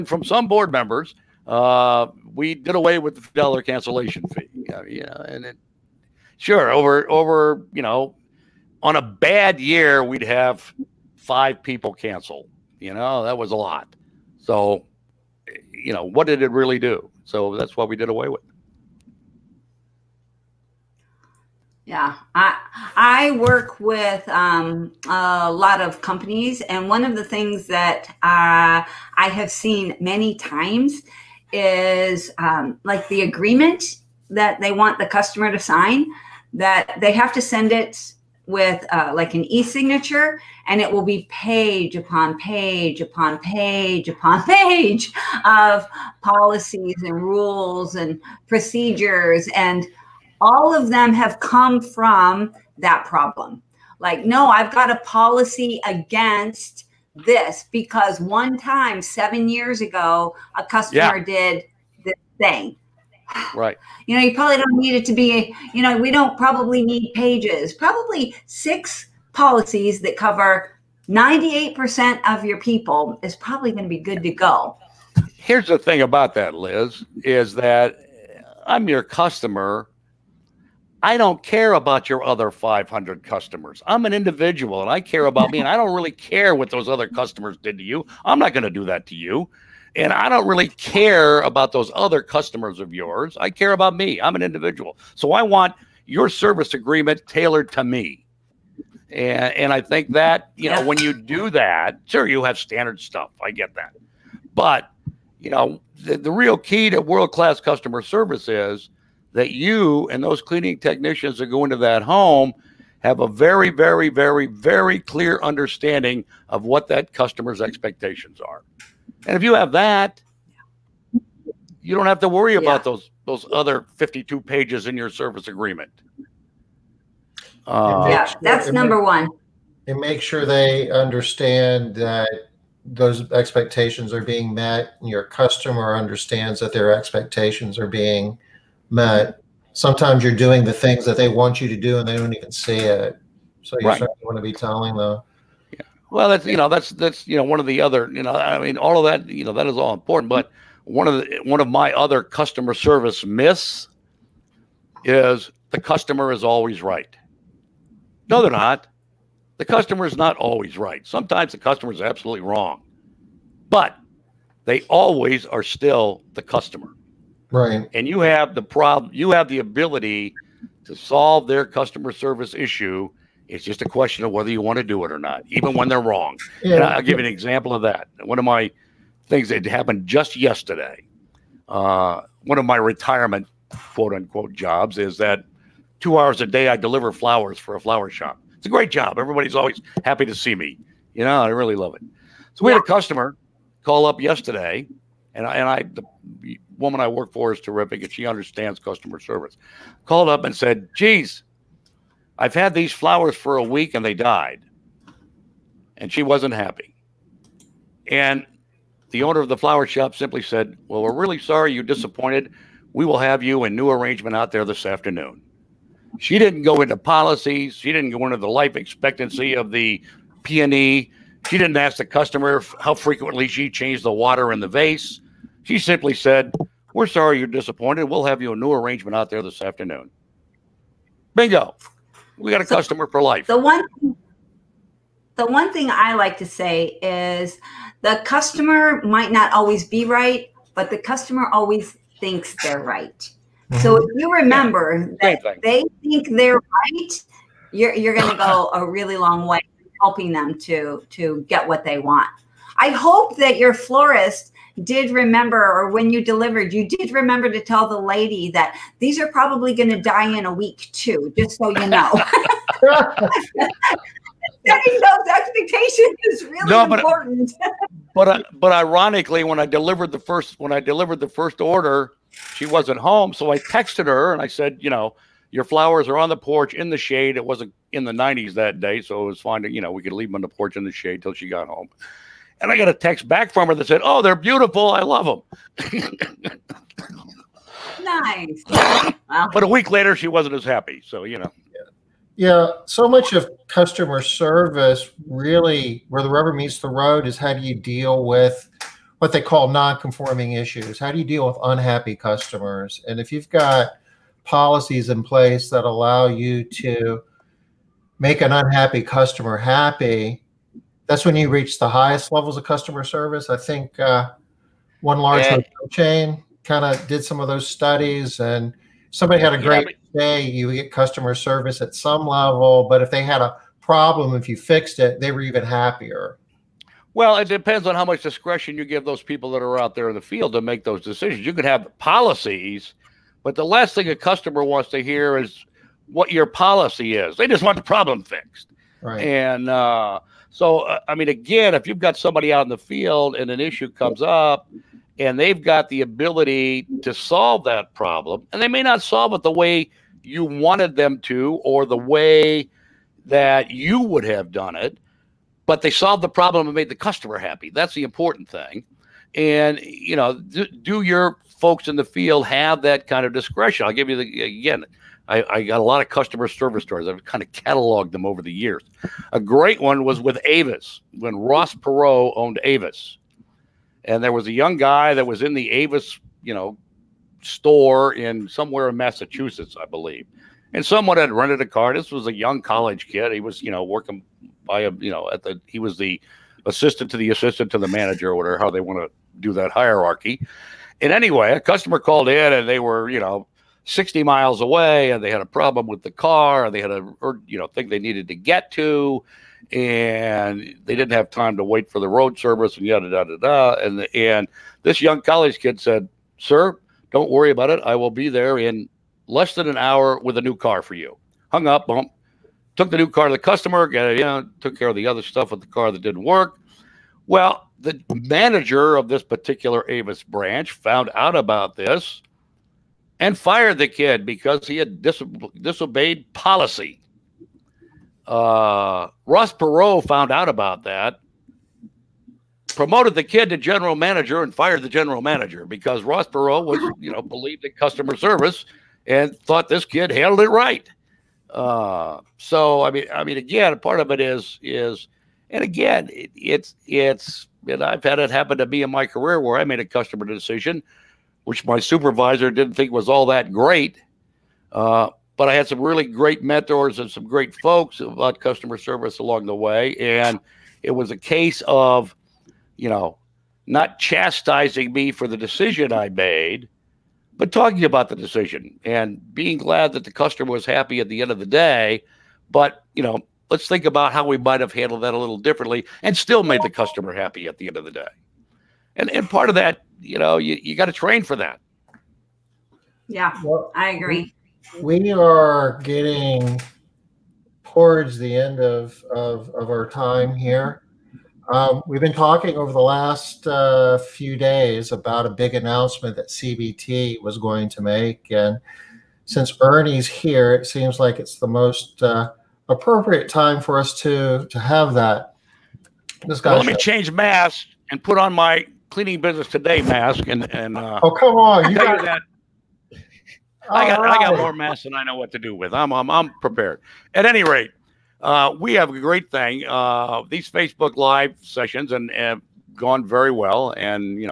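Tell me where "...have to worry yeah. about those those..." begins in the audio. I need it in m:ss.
2:02.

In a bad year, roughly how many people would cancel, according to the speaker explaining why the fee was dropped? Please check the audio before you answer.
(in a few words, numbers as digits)
5.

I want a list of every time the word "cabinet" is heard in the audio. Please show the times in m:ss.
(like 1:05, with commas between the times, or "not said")
not said.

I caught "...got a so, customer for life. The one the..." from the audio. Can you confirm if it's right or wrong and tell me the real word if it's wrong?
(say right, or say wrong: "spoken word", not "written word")
right.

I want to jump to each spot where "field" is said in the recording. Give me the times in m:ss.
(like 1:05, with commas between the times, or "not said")
5:30, 5:42, 6:02.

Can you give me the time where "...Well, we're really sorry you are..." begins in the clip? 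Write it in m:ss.
3:30.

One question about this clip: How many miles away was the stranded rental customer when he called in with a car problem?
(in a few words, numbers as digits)
60.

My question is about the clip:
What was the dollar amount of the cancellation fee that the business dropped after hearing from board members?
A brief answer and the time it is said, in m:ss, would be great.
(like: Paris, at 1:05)
$50, at 0:03.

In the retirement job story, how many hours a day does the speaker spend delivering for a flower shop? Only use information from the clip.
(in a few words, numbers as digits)
2.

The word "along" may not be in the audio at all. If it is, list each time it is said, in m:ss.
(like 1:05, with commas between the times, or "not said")
7:39.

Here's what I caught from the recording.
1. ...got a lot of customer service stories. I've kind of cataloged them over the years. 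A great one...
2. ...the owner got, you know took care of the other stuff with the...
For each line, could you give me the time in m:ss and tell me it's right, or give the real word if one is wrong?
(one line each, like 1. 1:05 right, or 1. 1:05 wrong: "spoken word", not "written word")
1. 6:05 right
2. 6:53 wrong: "customer", not "owner".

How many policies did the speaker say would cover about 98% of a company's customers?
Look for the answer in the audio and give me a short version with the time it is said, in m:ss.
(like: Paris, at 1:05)
6, at 1:08.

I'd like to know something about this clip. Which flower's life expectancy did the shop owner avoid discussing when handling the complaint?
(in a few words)
peony.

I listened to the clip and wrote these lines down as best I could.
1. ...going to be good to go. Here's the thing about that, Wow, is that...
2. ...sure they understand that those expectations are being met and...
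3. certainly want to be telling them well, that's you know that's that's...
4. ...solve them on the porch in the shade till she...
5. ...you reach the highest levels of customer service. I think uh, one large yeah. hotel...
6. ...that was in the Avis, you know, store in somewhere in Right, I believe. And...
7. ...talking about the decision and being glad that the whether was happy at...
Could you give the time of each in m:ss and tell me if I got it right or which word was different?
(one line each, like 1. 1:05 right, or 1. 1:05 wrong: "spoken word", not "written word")
1. 1:13 wrong: "Liz", not "Wow"
2. 2:10 right
3. 2:23 right
4. 4:40 wrong: "leave", not "solve"
5. 5:11 right
6. 6:15 wrong: "Massachusetts", not "Right"
7. 7:47 wrong: "customer", not "whether".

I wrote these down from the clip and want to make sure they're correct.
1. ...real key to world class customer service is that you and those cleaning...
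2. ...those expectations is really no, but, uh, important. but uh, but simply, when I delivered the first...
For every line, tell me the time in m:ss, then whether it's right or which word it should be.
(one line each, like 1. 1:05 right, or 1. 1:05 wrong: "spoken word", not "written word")
1. 1:46 right
2. 4:25 wrong: "ironically", not "simply".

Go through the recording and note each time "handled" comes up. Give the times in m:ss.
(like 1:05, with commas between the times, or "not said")
7:20, 7:54.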